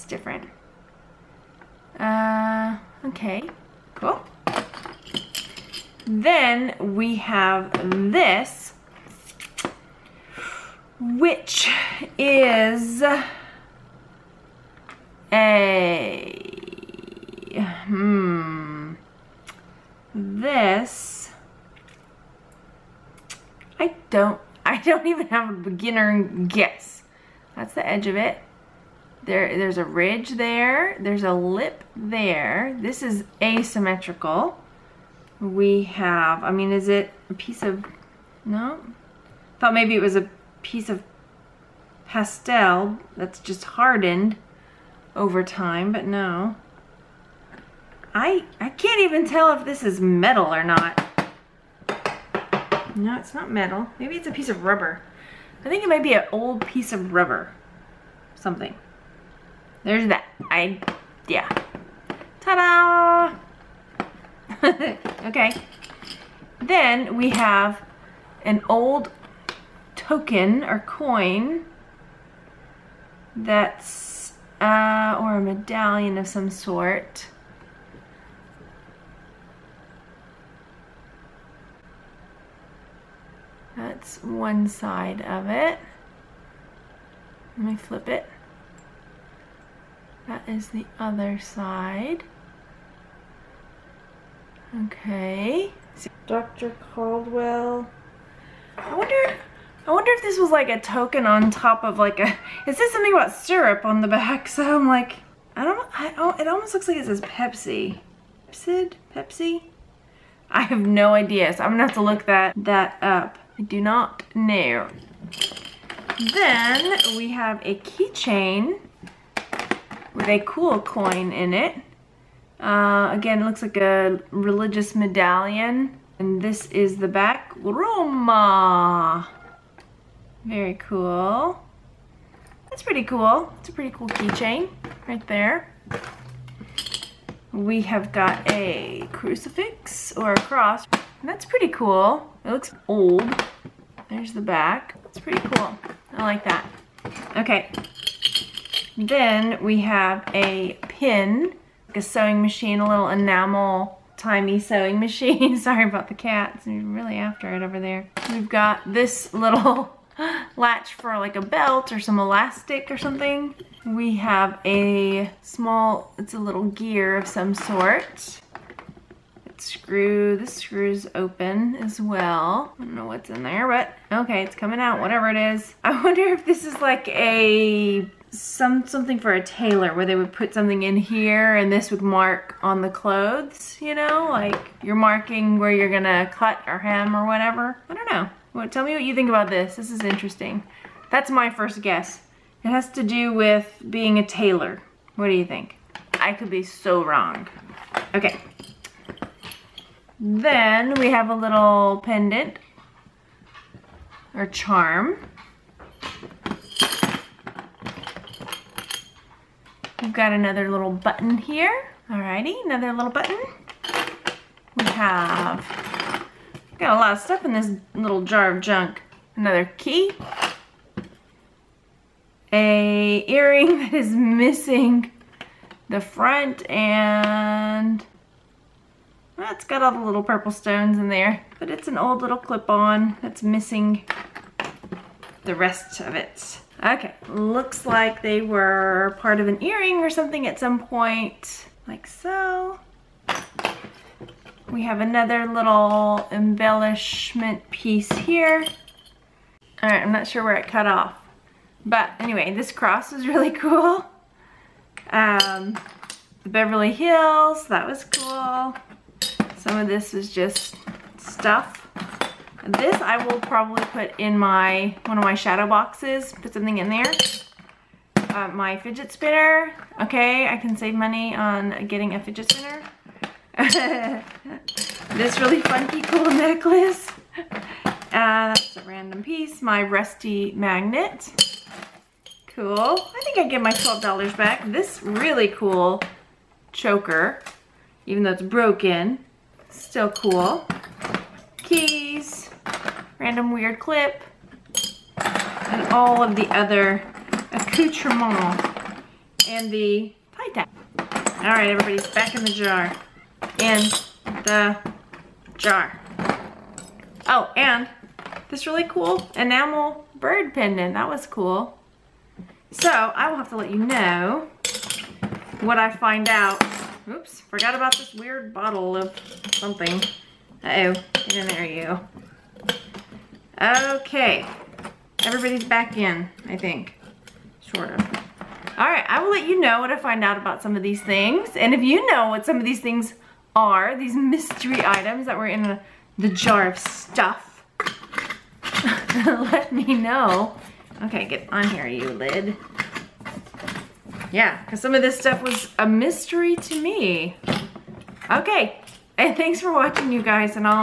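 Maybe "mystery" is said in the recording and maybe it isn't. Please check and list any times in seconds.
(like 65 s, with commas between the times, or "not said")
334 s, 345 s.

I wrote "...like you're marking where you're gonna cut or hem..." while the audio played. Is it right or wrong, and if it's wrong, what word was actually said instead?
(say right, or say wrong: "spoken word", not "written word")
right.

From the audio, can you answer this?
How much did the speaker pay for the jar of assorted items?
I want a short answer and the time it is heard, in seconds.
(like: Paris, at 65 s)
$12, at 283 s.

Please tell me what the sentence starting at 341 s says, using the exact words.
Okay, get on here, you lid.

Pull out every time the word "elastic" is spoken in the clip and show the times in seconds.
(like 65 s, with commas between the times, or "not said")
162 s.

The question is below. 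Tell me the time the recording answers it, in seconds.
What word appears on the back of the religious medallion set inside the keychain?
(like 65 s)
127 s.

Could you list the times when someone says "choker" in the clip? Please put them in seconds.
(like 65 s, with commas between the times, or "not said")
286 s.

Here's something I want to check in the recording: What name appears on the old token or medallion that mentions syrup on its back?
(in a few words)
Dr. Caldwell.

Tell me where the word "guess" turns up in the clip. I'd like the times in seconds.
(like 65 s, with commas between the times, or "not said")
26 s, 191 s.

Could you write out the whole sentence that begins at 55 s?
I think it might be an old piece of rubber.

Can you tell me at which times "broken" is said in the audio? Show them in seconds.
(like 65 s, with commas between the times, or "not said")
288 s.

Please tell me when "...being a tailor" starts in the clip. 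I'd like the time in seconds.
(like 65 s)
193 s.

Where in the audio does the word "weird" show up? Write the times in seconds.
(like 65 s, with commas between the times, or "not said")
293 s, 318 s.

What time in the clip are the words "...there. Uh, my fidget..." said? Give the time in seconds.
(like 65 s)
266 s.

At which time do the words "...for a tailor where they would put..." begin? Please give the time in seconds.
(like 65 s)
179 s.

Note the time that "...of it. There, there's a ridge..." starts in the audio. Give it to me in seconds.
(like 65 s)
28 s.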